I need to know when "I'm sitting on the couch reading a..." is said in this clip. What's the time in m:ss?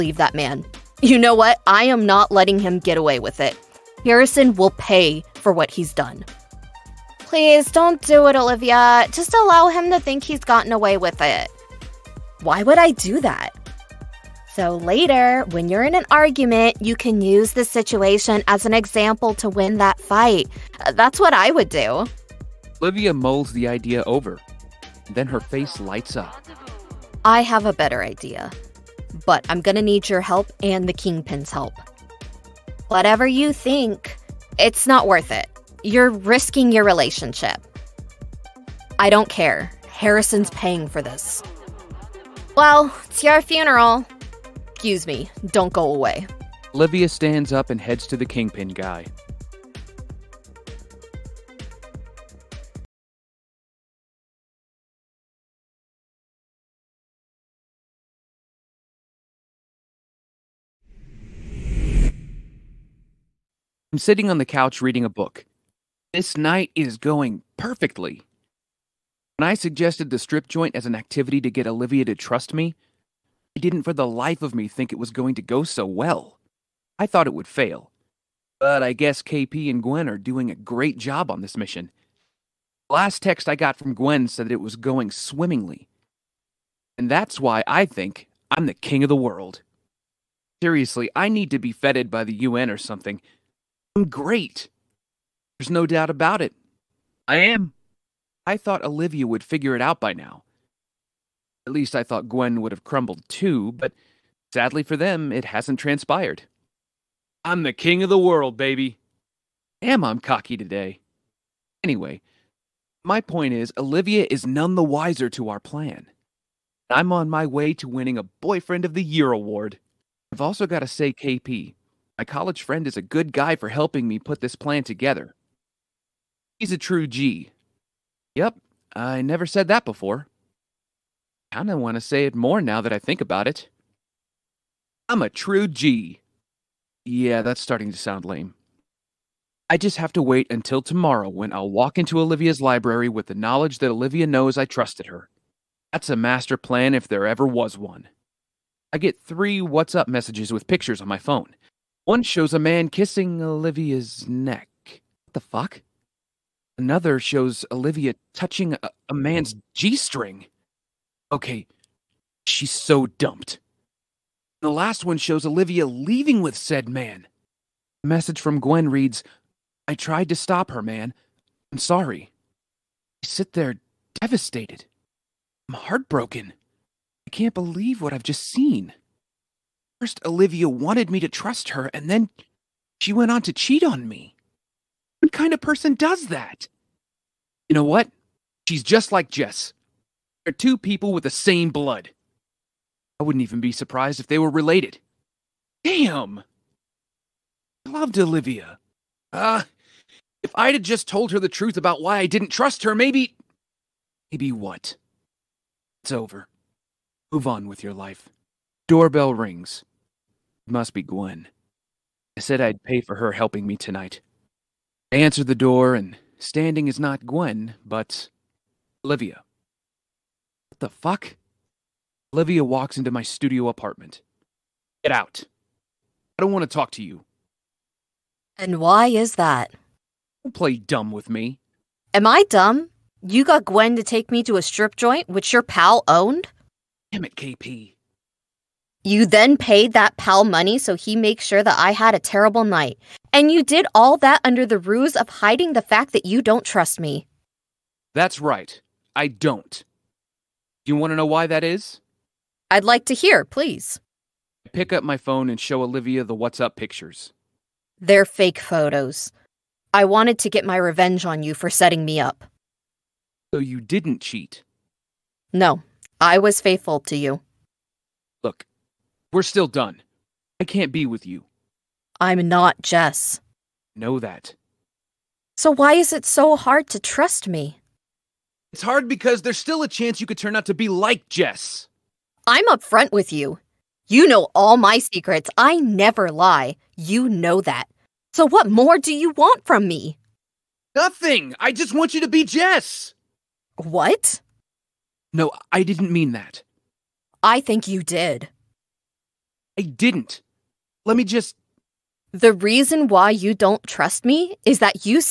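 1:03.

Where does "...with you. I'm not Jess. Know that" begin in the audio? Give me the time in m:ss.
4:31.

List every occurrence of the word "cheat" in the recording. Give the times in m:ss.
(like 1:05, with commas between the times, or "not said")
3:03, 4:24.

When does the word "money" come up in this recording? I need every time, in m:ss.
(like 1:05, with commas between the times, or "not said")
4:00.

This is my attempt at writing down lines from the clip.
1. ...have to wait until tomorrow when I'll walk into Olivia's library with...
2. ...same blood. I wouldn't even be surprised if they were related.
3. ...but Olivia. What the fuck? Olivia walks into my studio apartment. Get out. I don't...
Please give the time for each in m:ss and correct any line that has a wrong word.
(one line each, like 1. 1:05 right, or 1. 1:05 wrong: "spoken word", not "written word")
1. 2:19 right
2. 3:11 right
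3. 3:37 right.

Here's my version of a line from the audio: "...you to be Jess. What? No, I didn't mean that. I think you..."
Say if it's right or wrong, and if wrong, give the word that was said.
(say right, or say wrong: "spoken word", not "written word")
right.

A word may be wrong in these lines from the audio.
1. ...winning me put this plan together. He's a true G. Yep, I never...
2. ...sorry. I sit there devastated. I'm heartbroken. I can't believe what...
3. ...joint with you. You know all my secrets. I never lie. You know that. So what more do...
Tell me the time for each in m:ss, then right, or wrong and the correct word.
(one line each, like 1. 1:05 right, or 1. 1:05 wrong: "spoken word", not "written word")
1. 2:03 wrong: "helping", not "winning"
2. 2:51 right
3. 4:42 wrong: "upfront", not "joint".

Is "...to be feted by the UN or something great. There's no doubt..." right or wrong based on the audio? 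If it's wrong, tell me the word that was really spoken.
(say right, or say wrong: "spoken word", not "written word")
right.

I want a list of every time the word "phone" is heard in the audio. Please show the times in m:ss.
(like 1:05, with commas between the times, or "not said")
2:31, 4:15.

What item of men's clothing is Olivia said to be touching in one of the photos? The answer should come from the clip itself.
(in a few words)
G string.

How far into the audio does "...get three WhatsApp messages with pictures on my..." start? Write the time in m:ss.
2:28.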